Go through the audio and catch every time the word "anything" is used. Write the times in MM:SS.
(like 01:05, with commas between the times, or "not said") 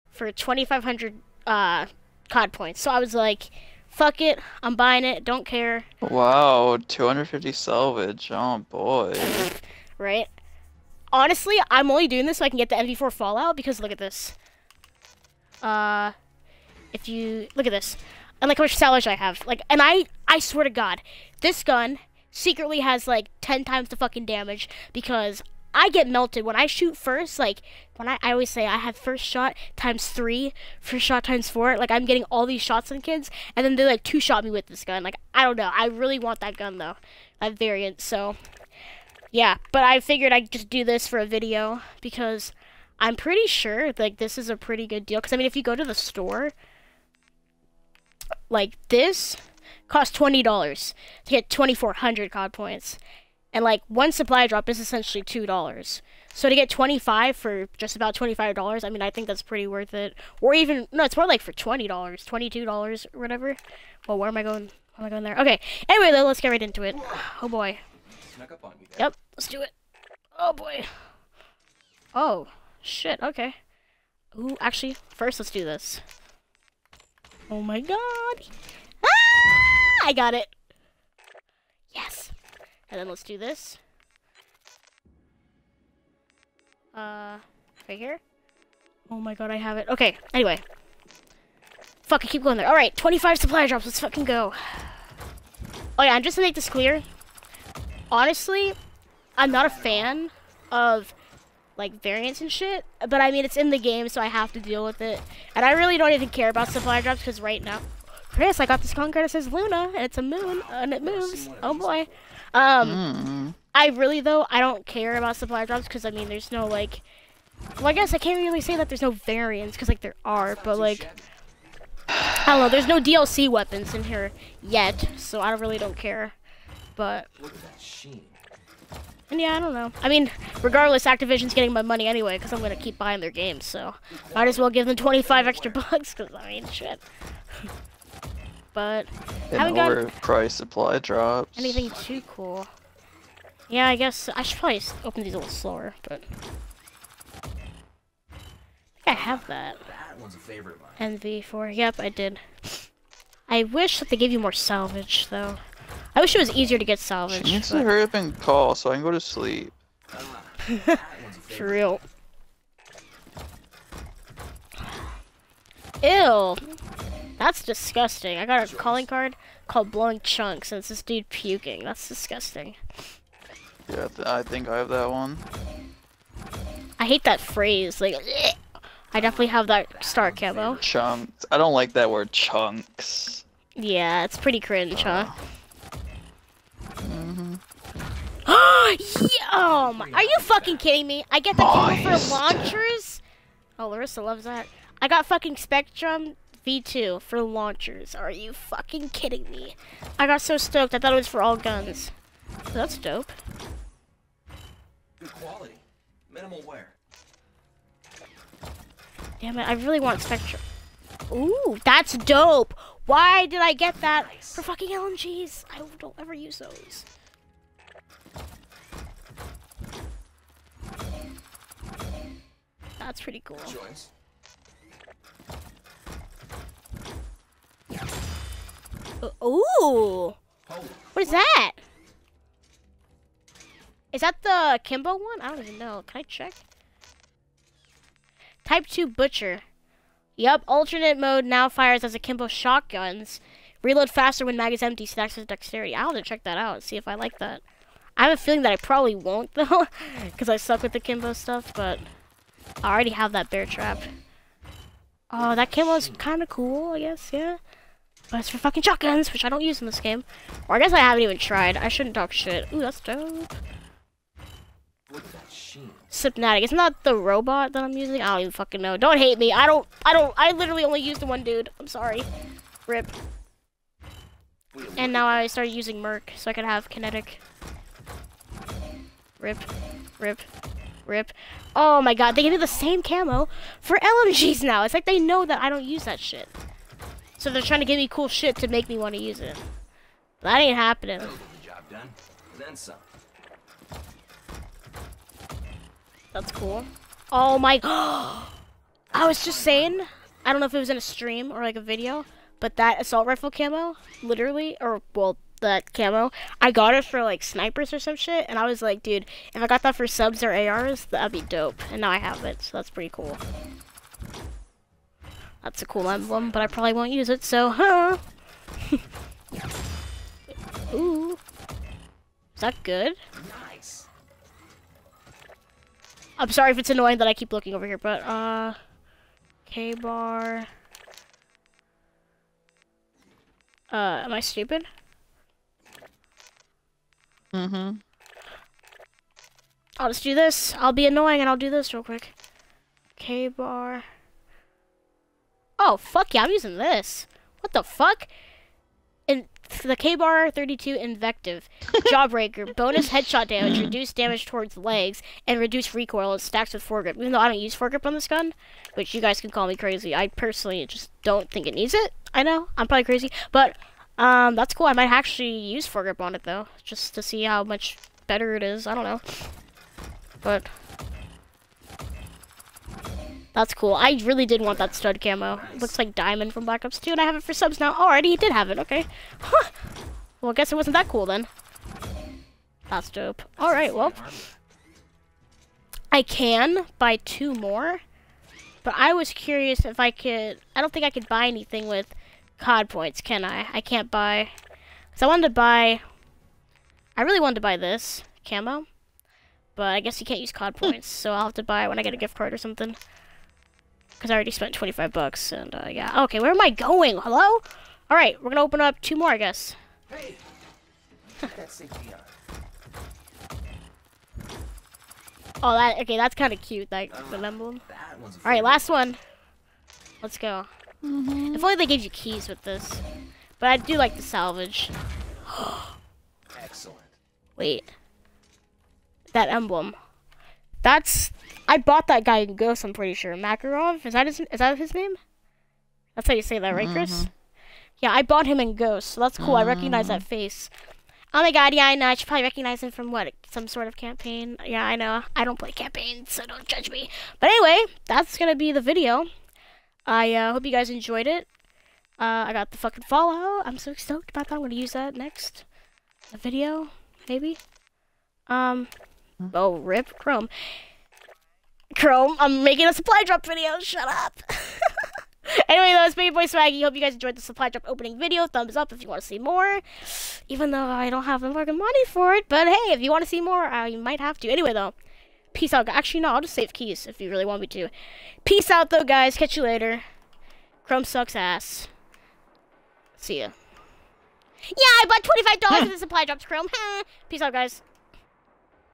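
02:21, 06:31.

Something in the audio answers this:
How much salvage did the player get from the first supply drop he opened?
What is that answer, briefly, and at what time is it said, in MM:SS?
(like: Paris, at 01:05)
250, at 00:06.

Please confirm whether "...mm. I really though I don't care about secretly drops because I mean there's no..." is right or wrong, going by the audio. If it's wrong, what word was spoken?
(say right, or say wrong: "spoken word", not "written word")
wrong: "supply", not "secretly".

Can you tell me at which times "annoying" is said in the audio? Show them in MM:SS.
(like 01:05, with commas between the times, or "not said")
05:26, 05:41.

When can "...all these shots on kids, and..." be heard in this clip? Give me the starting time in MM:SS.
00:32.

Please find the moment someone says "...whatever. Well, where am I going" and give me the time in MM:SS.
01:03.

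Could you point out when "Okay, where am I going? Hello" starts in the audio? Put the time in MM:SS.
06:46.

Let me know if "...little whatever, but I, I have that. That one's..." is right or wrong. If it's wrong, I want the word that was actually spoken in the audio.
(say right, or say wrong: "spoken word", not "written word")
wrong: "slower", not "whatever".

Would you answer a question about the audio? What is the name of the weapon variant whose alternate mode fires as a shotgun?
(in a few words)
Type 2 Butcher.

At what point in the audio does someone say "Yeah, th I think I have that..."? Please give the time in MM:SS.
02:53.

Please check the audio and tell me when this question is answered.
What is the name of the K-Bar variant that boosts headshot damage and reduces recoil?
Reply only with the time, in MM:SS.
05:52.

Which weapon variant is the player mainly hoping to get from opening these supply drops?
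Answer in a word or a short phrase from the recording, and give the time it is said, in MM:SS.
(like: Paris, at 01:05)
NV4 Fallout, at 00:12.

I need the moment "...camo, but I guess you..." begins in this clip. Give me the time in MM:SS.
06:38.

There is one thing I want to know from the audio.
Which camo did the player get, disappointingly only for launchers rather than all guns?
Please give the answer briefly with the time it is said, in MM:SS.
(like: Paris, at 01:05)
Spectrum V2, at 03:15.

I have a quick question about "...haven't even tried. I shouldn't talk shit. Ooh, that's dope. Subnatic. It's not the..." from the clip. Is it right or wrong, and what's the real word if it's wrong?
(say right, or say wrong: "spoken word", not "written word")
right.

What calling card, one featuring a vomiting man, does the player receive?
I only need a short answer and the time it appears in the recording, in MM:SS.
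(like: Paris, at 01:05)
Blowing Chunks, at 02:49.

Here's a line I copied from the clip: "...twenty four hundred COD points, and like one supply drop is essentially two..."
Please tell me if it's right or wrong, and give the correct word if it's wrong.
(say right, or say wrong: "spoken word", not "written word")
right.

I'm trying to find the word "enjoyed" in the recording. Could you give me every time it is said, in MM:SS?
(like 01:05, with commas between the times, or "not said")
07:30, 07:47.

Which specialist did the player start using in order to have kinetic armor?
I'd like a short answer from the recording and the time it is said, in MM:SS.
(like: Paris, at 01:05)
Merc, at 04:36.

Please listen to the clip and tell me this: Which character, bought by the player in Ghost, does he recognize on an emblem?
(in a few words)
Makarov.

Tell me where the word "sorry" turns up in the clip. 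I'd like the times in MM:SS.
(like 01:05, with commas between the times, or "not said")
04:31, 05:26.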